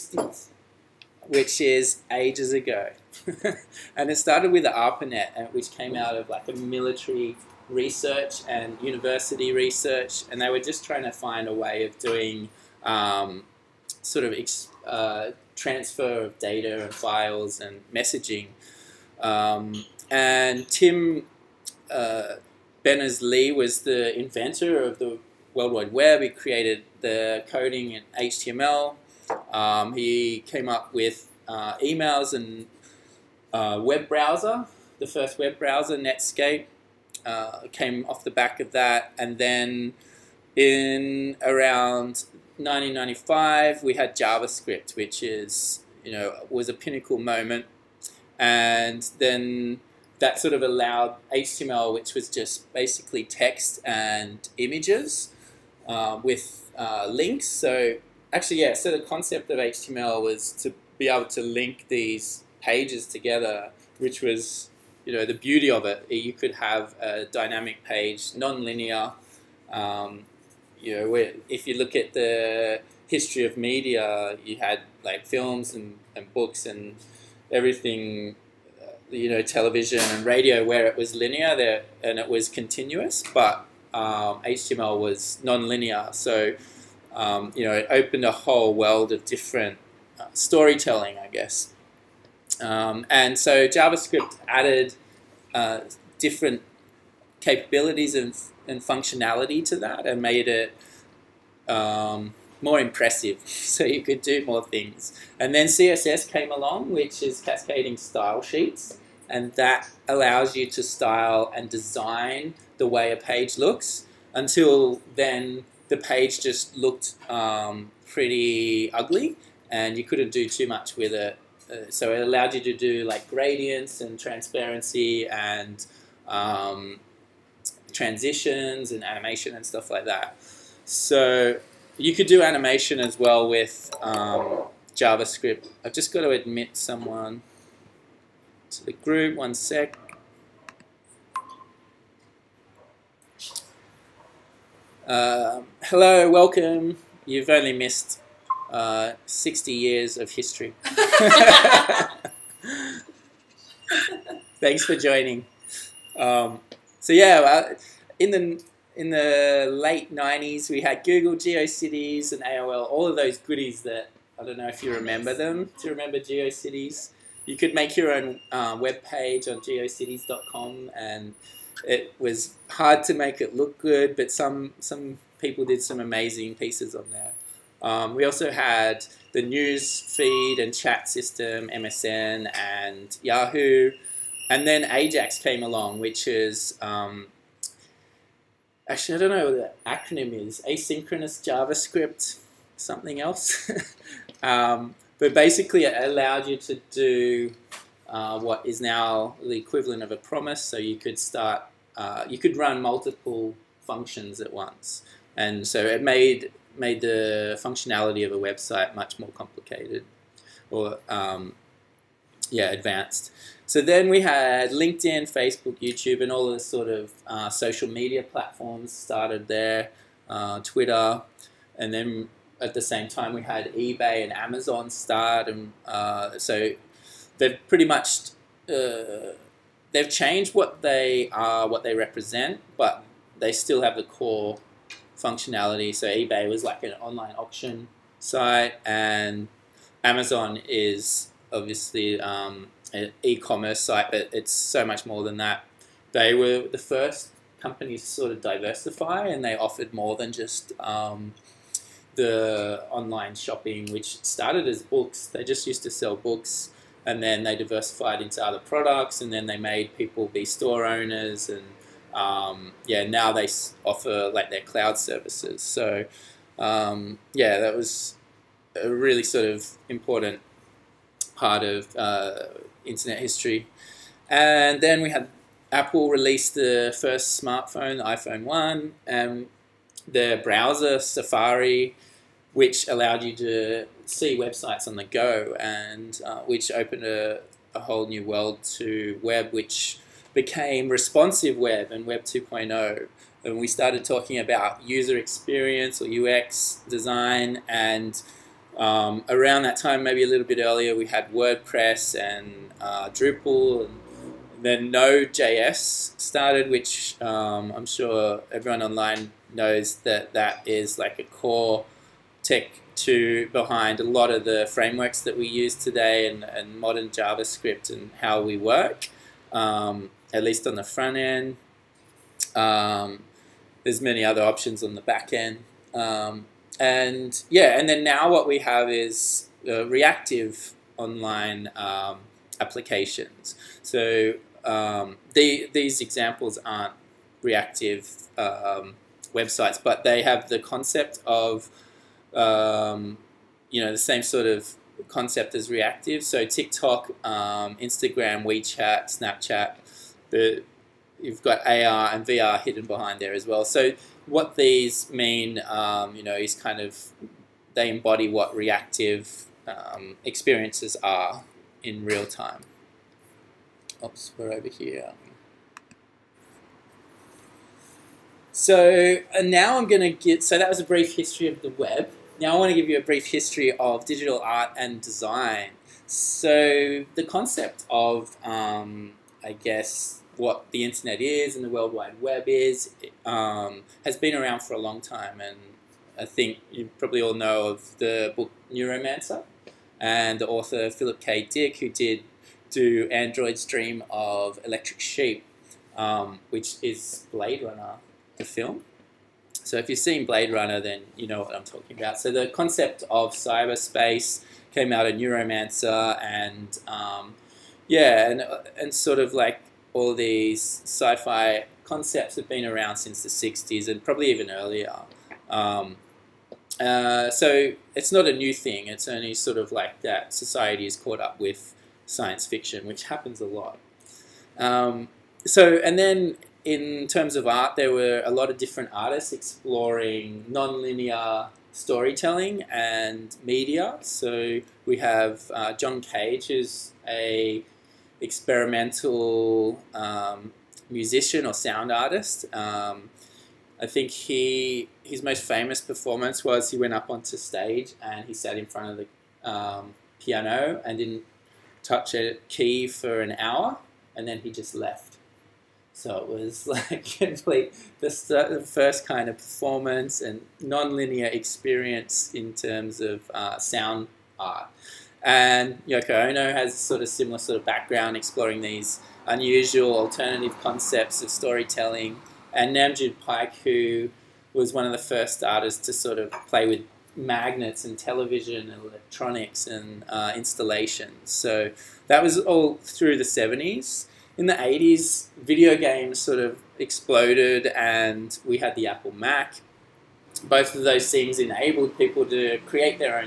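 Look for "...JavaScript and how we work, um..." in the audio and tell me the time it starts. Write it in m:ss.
5:17.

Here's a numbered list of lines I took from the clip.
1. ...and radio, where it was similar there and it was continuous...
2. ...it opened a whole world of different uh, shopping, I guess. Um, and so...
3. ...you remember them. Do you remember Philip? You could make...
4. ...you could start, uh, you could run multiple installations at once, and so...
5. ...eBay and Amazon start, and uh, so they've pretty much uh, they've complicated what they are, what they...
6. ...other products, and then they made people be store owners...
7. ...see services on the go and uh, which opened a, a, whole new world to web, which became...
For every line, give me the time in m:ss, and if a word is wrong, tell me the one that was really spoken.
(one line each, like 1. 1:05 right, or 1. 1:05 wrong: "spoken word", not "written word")
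1. 1:20 wrong: "linear", not "similar"
2. 1:27 wrong: "storytelling", not "shopping"
3. 2:44 wrong: "GeoCities", not "Philip"
4. 3:20 wrong: "functions", not "installations"
5. 3:43 wrong: "changed", not "complicated"
6. 4:18 right
7. 4:44 wrong: "websites", not "services".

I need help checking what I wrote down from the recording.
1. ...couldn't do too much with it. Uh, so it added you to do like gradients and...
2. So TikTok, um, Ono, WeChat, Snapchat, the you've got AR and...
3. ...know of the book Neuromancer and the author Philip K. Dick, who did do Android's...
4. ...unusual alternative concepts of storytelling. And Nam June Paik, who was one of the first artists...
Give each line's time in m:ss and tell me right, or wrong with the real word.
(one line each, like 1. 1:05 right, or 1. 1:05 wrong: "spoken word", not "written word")
1. 2:00 wrong: "allowed", not "added"
2. 5:46 wrong: "Instagram", not "Ono"
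3. 6:27 right
4. 7:49 right.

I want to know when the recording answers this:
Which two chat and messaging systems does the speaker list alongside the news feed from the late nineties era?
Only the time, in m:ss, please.
3:01.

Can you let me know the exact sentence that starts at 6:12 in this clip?
Now I want to give you a brief history of digital art and design.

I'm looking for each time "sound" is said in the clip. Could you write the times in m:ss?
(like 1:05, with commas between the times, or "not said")
7:21, 7:43.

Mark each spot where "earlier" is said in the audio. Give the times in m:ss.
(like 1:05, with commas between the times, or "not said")
5:00, 6:54.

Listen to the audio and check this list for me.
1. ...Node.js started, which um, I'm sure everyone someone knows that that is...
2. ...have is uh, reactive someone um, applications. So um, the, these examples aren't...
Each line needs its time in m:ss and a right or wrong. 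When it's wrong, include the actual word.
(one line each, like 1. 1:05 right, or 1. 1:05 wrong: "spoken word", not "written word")
1. 5:04 wrong: "online", not "someone"
2. 5:28 wrong: "online", not "someone".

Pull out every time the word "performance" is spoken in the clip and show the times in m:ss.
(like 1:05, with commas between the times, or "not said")
7:25, 7:39.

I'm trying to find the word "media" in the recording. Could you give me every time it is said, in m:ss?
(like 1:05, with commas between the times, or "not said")
1:13, 3:37, 7:13.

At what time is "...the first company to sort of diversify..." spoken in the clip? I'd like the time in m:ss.
4:06.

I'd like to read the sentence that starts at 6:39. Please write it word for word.
So if you've seen Blade Runner, then you know what I'm talking about.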